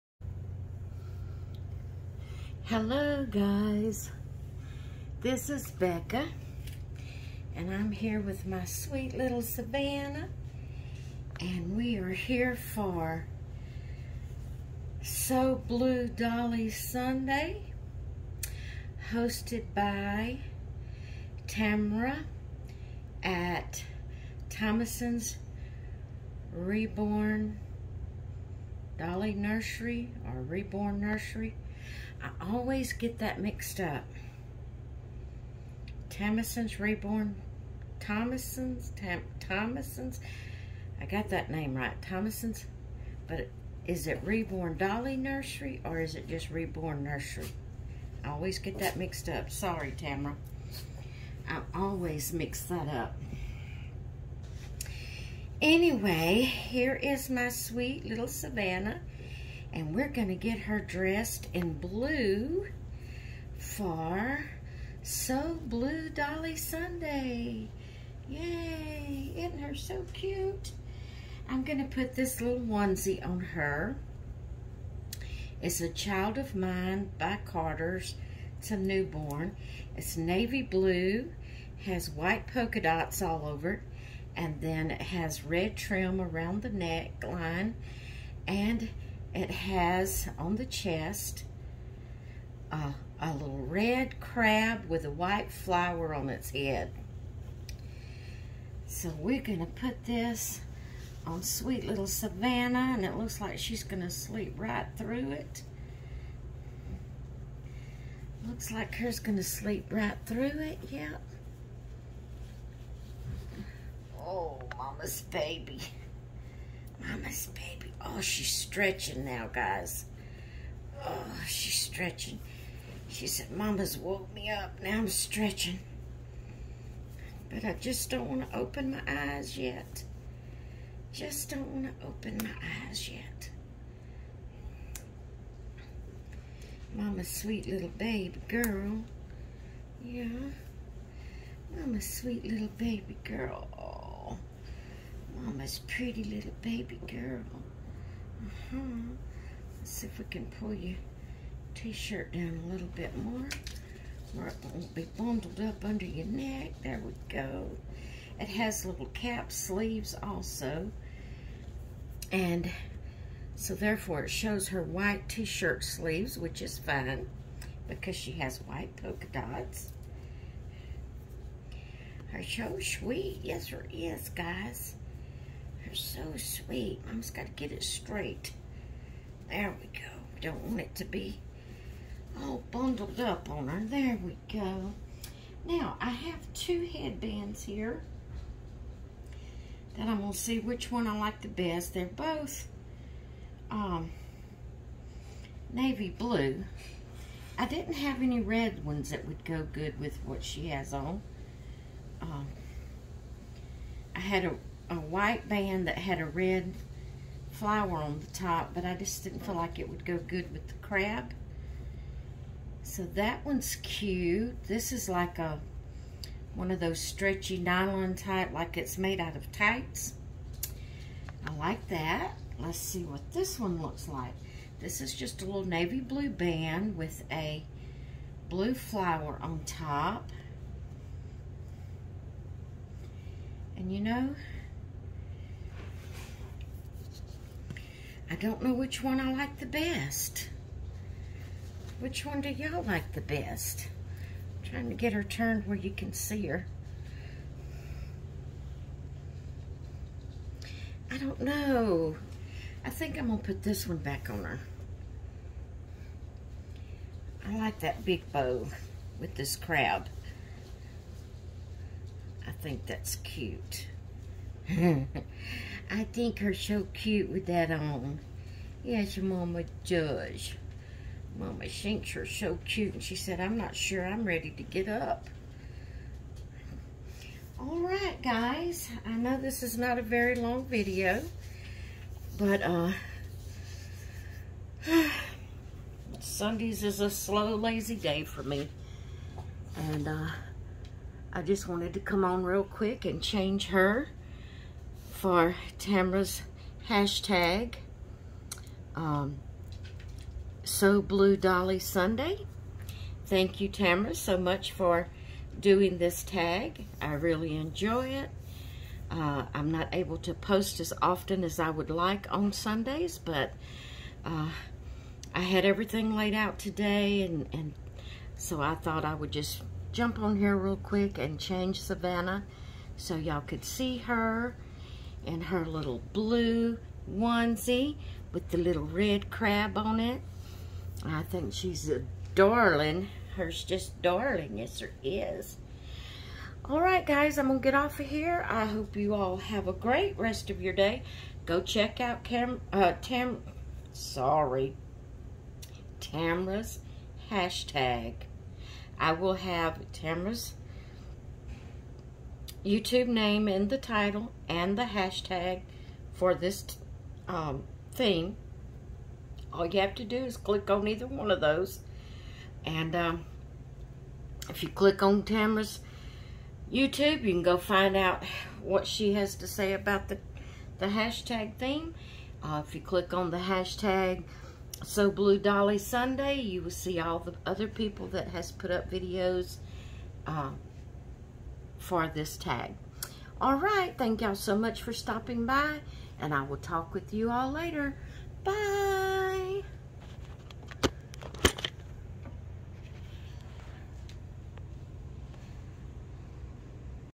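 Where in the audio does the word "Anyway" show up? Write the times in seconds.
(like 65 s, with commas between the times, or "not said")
55 s.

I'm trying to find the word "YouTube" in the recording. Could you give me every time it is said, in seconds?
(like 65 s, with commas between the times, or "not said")
352 s, 366 s.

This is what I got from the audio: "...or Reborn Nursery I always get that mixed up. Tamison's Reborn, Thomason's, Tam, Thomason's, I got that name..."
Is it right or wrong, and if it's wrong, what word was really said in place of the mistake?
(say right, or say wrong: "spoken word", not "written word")
right.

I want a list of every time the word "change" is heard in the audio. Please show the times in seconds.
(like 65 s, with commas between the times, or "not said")
293 s, 321 s.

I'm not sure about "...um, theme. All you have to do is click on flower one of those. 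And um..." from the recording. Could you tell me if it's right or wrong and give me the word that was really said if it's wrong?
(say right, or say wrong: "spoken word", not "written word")
wrong: "either", not "flower".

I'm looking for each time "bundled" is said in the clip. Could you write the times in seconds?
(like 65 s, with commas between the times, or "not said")
155 s, 182 s.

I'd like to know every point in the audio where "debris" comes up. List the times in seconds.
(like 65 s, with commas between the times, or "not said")
not said.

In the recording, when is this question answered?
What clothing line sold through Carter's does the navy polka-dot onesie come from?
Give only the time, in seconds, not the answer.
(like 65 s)
75 s.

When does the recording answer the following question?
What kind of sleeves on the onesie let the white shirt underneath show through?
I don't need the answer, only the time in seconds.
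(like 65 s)
159 s.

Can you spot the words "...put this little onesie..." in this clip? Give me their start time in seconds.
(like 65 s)
71 s.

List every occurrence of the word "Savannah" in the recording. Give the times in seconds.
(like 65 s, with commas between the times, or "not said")
9 s, 58 s, 102 s, 321 s.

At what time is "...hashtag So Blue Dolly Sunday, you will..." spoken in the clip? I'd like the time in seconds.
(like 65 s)
373 s.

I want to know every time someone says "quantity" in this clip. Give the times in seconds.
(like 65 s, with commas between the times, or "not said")
not said.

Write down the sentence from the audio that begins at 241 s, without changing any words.
Which one do y'all like the best?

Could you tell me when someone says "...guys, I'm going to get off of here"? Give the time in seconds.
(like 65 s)
337 s.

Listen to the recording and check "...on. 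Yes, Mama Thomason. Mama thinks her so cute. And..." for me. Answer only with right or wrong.
wrong.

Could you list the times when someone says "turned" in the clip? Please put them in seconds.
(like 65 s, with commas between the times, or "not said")
245 s.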